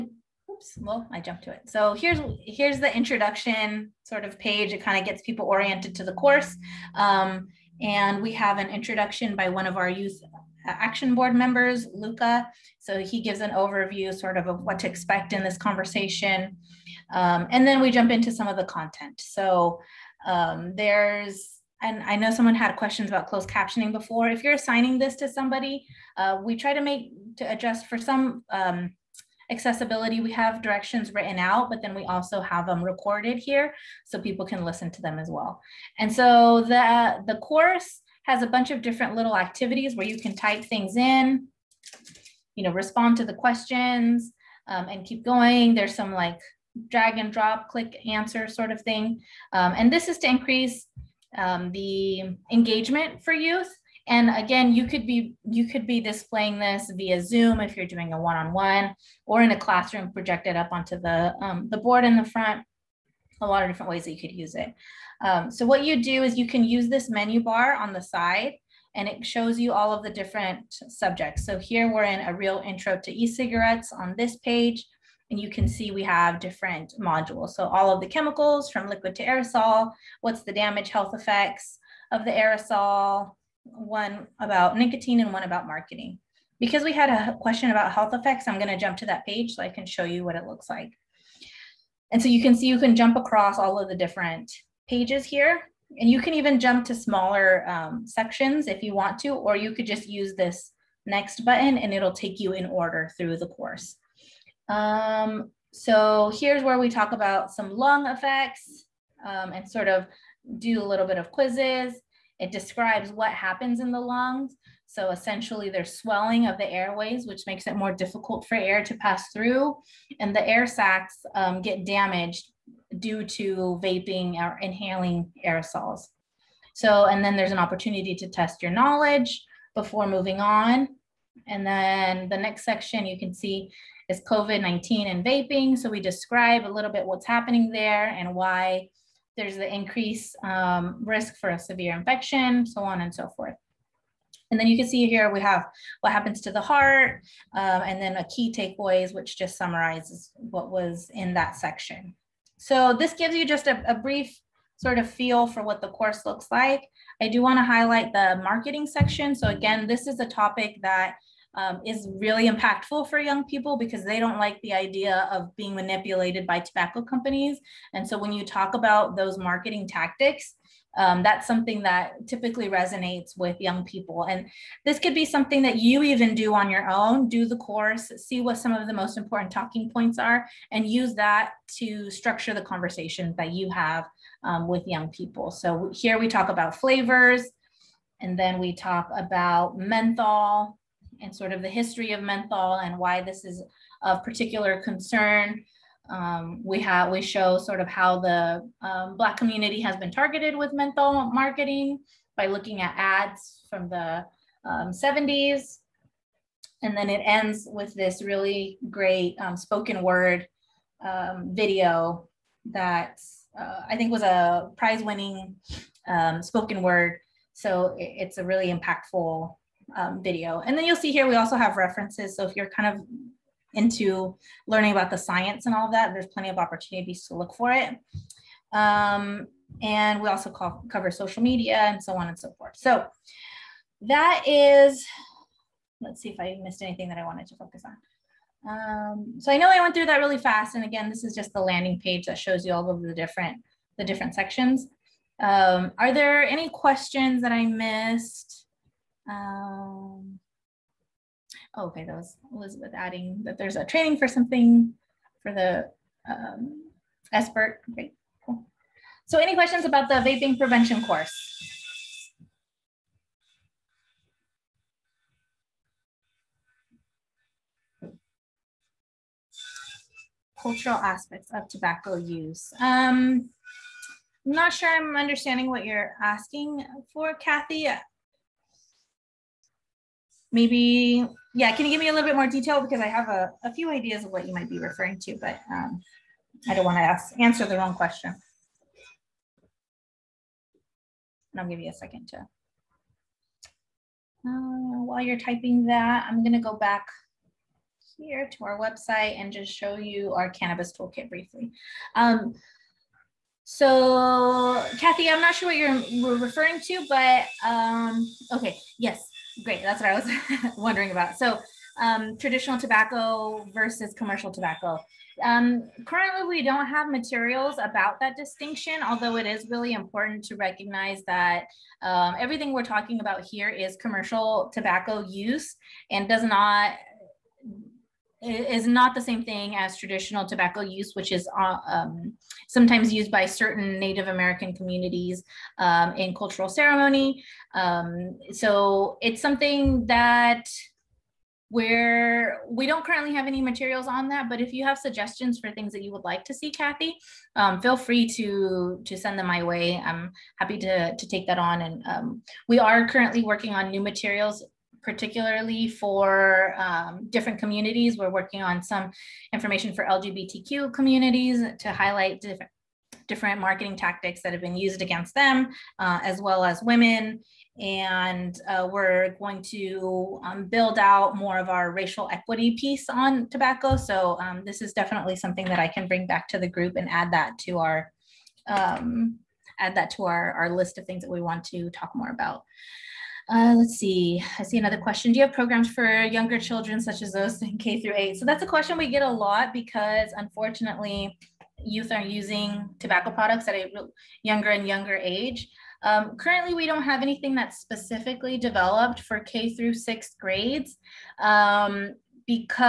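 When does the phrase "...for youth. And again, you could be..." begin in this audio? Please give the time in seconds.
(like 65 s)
53 s.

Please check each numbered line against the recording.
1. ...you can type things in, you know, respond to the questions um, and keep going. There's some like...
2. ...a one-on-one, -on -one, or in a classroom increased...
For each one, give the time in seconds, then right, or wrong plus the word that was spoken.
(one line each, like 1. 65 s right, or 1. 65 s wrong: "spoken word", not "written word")
1. 40 s right
2. 58 s wrong: "projected", not "increased".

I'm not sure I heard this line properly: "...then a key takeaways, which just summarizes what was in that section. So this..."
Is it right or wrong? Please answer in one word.
right.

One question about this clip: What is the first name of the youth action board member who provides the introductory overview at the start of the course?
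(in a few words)
Luca.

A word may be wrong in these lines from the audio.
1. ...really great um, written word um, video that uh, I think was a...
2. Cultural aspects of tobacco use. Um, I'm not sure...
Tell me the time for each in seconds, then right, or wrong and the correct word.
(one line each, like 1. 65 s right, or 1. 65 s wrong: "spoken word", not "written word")
1. 208 s wrong: "spoken", not "written"
2. 270 s right.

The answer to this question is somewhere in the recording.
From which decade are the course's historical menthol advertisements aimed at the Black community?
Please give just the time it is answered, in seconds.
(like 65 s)
204 s.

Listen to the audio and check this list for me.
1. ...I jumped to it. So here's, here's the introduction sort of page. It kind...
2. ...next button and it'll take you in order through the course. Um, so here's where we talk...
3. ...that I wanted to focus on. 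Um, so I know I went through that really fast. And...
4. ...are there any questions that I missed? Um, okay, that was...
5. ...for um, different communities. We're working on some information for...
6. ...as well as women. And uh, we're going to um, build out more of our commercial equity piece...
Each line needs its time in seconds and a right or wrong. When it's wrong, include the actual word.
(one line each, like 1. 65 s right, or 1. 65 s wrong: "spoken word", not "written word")
1. 1 s right
2. 101 s right
3. 237 s right
4. 245 s right
5. 355 s right
6. 366 s wrong: "racial", not "commercial".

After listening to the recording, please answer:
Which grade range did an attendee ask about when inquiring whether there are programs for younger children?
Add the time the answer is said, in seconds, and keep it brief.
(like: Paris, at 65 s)
K through 8, at 387 s.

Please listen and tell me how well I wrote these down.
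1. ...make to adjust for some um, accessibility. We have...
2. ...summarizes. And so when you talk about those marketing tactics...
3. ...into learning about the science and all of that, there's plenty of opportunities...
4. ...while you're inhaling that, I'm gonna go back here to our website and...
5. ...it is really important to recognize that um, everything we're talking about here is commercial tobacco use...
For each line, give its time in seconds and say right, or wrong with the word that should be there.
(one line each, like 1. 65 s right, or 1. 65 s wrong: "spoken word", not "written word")
1. 26 s right
2. 167 s wrong: "companies", not "summarizes"
3. 223 s right
4. 295 s wrong: "typing", not "inhaling"
5. 319 s right.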